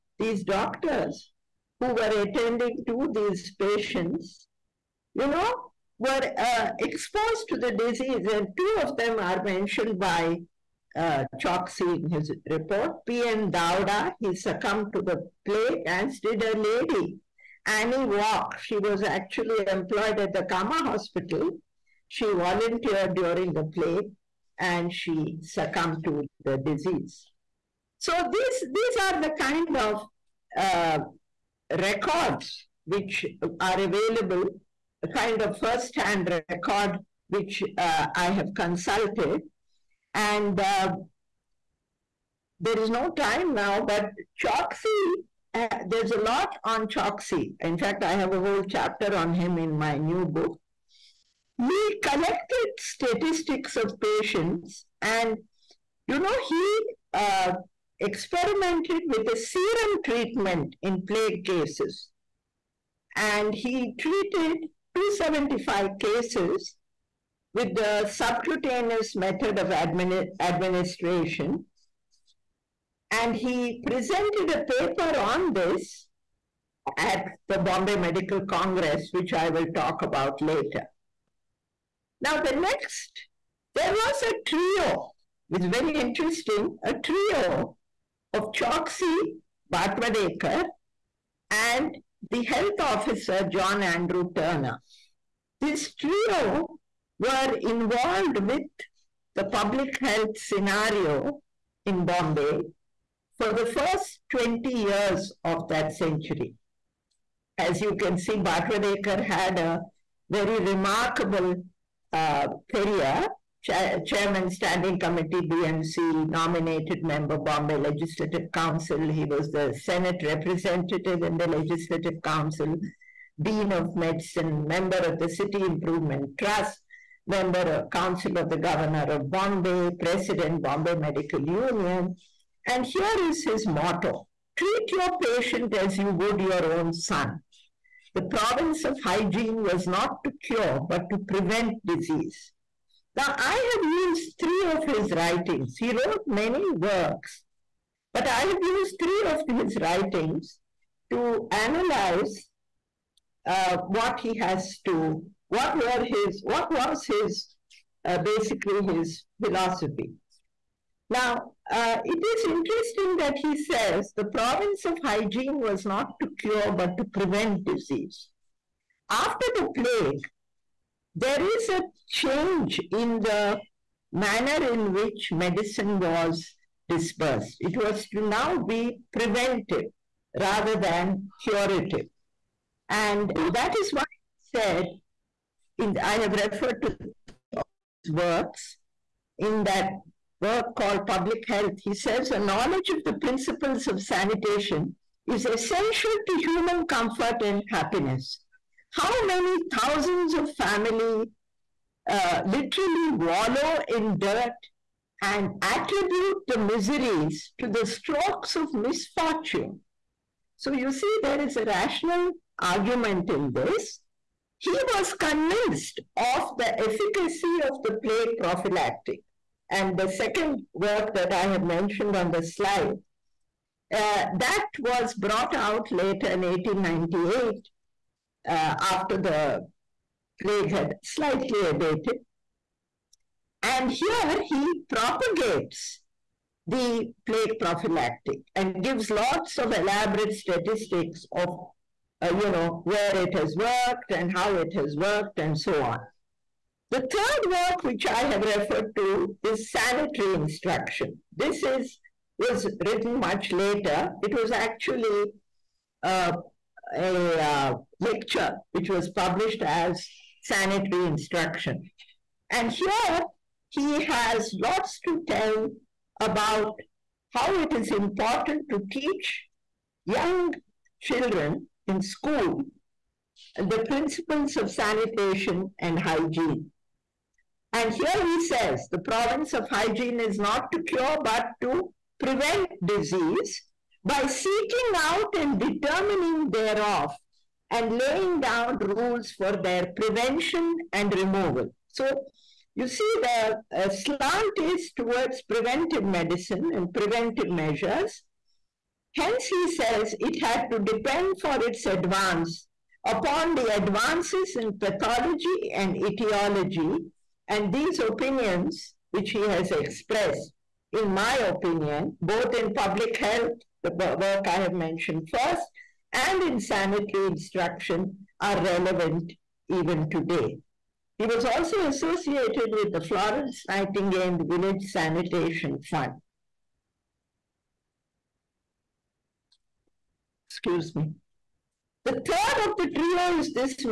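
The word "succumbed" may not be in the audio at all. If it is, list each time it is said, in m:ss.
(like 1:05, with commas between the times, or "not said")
0:14, 0:25.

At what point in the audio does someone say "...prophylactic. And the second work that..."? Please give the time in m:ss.
3:38.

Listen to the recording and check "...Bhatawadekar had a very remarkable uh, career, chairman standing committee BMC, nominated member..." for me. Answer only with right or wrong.
right.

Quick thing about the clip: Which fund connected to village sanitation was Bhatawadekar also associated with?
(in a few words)
Florence Nightingale Village Sanitation Fund.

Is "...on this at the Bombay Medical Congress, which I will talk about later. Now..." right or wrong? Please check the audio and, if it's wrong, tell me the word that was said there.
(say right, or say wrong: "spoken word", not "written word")
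right.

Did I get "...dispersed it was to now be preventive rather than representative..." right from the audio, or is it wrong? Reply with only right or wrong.
wrong.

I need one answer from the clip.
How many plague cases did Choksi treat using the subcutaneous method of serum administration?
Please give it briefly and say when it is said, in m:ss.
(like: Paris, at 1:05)
275, at 1:04.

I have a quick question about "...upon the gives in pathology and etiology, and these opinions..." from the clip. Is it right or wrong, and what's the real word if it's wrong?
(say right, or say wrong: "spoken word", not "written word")
wrong: "advances", not "gives".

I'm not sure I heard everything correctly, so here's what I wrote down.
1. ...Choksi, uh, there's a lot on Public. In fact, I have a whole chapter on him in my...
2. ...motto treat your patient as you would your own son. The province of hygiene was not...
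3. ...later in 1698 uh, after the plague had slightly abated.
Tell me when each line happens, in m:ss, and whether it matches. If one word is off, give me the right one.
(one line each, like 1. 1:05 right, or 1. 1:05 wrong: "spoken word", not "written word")
1. 0:44 wrong: "Choksi", not "Public"
2. 2:13 right
3. 3:45 wrong: "1898", not "1698".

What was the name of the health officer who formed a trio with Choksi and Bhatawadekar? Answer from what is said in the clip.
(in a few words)
John Andrew Turner.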